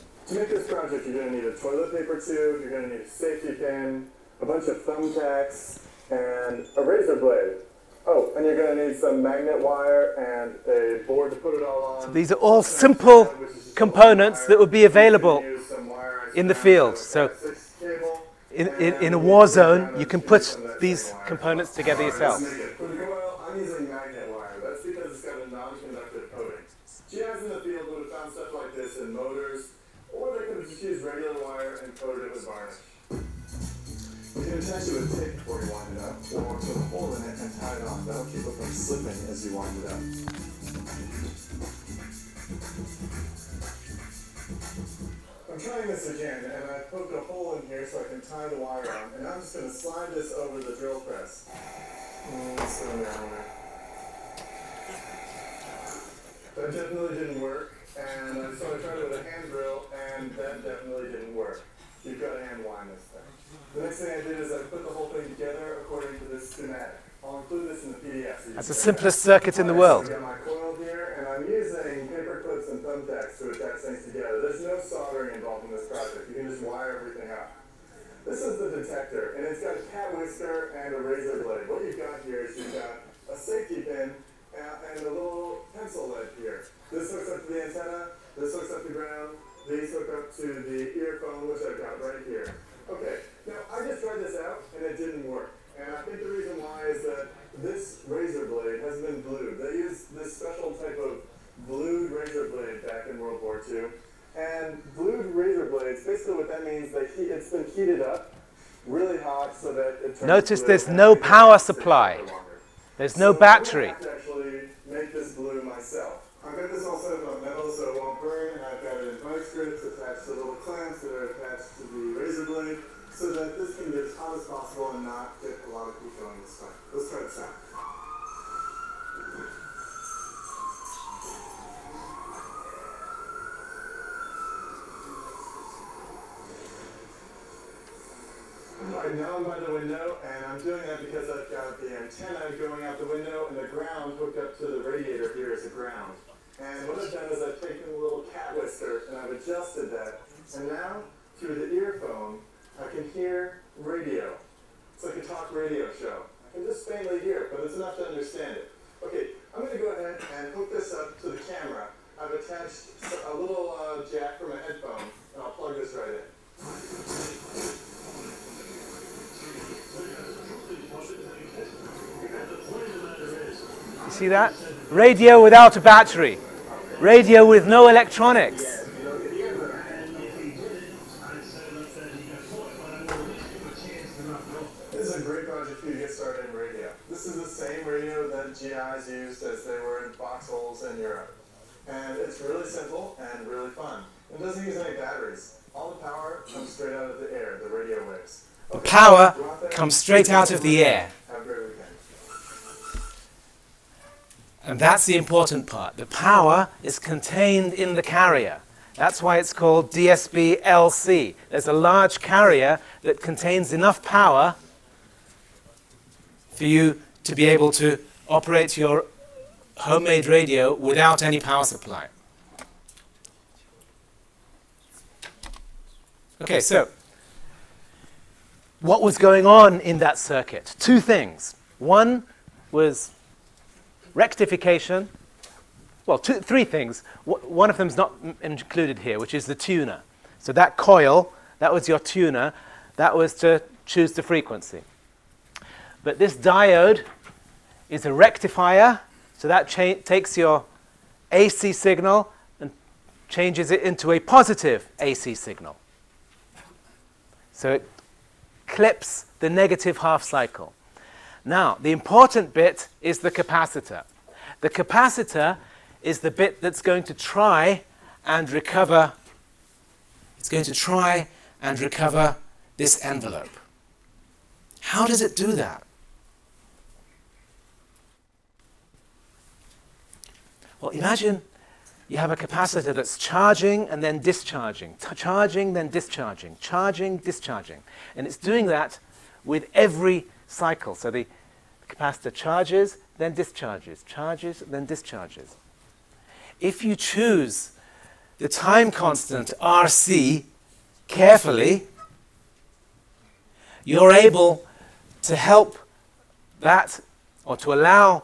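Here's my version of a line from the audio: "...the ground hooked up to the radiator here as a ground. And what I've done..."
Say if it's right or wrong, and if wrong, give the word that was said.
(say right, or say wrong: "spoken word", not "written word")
right.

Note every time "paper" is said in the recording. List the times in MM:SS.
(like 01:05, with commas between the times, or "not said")
00:01, 01:12.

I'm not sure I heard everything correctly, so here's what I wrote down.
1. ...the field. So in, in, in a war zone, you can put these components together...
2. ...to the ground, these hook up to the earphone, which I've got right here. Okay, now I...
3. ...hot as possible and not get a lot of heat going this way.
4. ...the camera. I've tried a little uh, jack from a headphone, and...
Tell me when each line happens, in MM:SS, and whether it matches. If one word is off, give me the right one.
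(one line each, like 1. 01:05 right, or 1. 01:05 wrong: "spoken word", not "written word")
1. 00:16 right
2. 01:28 right
3. 02:04 right
4. 02:41 wrong: "attached", not "tried".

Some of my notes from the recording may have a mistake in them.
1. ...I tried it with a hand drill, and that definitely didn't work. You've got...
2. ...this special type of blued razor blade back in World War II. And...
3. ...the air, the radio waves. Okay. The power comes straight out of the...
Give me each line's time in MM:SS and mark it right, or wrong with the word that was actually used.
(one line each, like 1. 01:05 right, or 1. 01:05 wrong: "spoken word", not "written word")
1. 00:58 right
2. 01:40 right
3. 03:17 right.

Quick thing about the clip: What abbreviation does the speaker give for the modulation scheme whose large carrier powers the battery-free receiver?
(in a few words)
DSB LC.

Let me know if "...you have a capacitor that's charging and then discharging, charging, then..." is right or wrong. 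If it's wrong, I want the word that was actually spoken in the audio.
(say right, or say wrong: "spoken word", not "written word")
right.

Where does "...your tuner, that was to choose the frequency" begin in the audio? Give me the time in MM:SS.
04:01.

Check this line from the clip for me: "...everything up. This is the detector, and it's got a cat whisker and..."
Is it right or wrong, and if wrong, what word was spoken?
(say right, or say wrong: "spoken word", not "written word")
right.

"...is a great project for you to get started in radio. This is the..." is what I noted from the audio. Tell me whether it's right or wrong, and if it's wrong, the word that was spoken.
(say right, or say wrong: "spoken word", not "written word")
right.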